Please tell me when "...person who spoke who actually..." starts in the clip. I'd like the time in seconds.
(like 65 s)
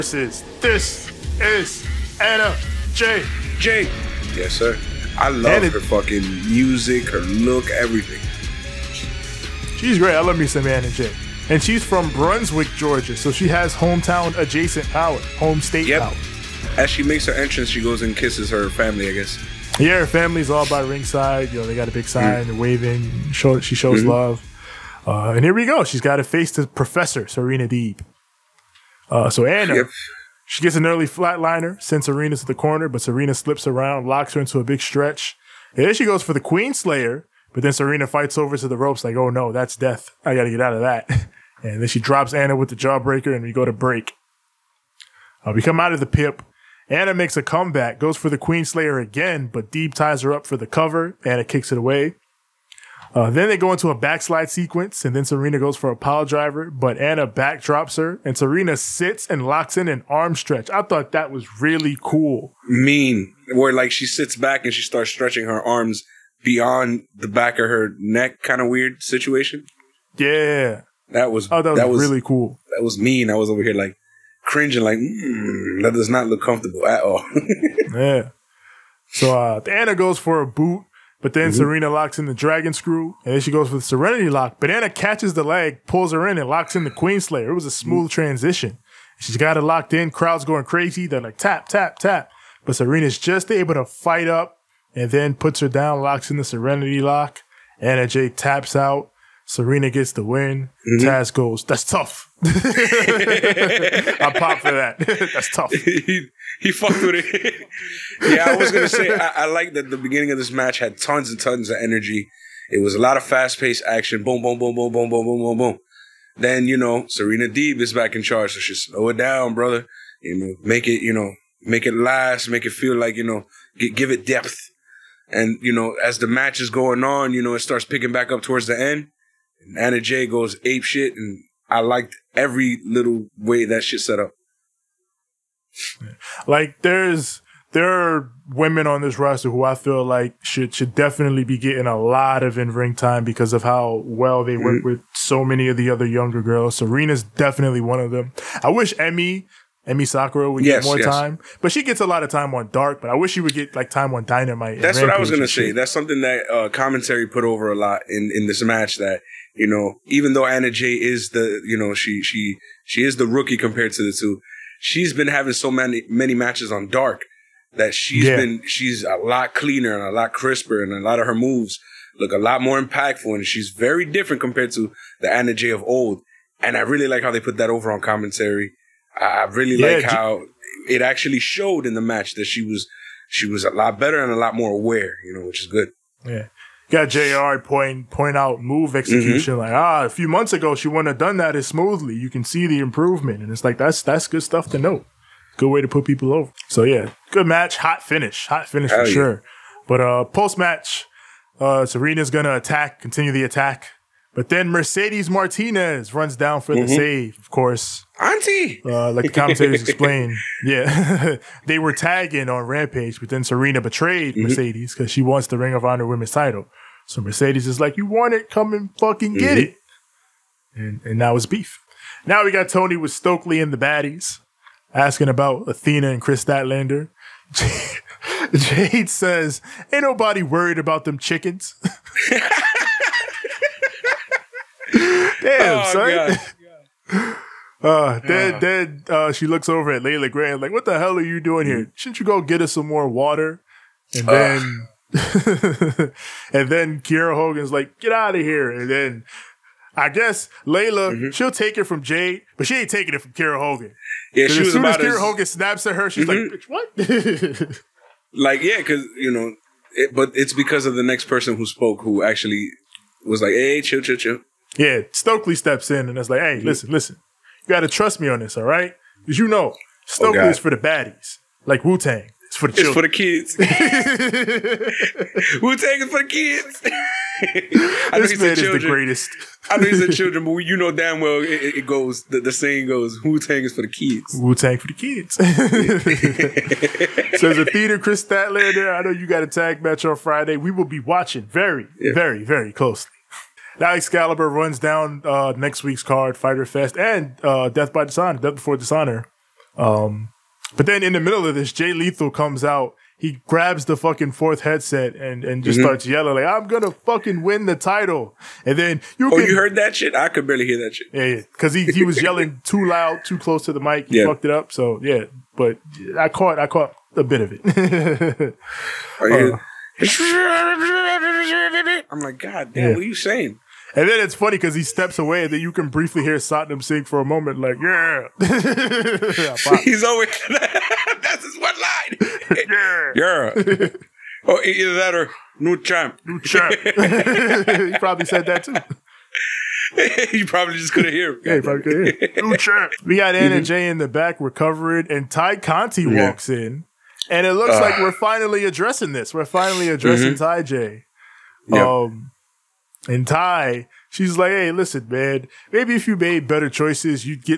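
261 s.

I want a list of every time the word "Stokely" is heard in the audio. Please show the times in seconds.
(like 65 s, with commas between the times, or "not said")
223 s, 265 s, 270 s.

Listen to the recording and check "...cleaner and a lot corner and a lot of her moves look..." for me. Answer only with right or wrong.
wrong.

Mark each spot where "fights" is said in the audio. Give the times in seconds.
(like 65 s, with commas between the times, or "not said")
38 s, 93 s.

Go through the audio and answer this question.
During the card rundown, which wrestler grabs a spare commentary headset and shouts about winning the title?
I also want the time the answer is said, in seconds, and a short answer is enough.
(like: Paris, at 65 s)
Jay Lethal, at 301 s.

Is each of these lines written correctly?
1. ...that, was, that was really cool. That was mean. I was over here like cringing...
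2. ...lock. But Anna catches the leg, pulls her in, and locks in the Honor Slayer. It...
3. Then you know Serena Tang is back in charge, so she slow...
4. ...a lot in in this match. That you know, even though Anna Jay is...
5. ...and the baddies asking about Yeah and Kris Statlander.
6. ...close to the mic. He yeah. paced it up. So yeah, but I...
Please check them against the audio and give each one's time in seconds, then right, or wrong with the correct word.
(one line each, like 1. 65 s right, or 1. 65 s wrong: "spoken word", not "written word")
1. 71 s right
2. 84 s wrong: "Queen", not "Honor"
3. 116 s wrong: "Deeb", not "Tang"
4. 157 s right
5. 223 s wrong: "Athena", not "Yeah"
6. 313 s wrong: "fucked", not "paced".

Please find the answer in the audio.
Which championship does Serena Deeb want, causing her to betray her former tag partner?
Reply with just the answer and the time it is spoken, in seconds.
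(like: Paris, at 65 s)
Ring of Honor women's title, at 215 s.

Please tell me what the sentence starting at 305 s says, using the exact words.
starts yelling like, "I'm gonna fucking win the title!" And then you oh, you heard that shit?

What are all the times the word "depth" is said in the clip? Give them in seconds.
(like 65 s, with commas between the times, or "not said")
124 s.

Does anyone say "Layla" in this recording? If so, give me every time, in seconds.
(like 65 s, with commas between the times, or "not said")
240 s, 250 s.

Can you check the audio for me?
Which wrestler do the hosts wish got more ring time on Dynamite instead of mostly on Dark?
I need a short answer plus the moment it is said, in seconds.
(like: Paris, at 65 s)
Emmy Sakura, at 149 s.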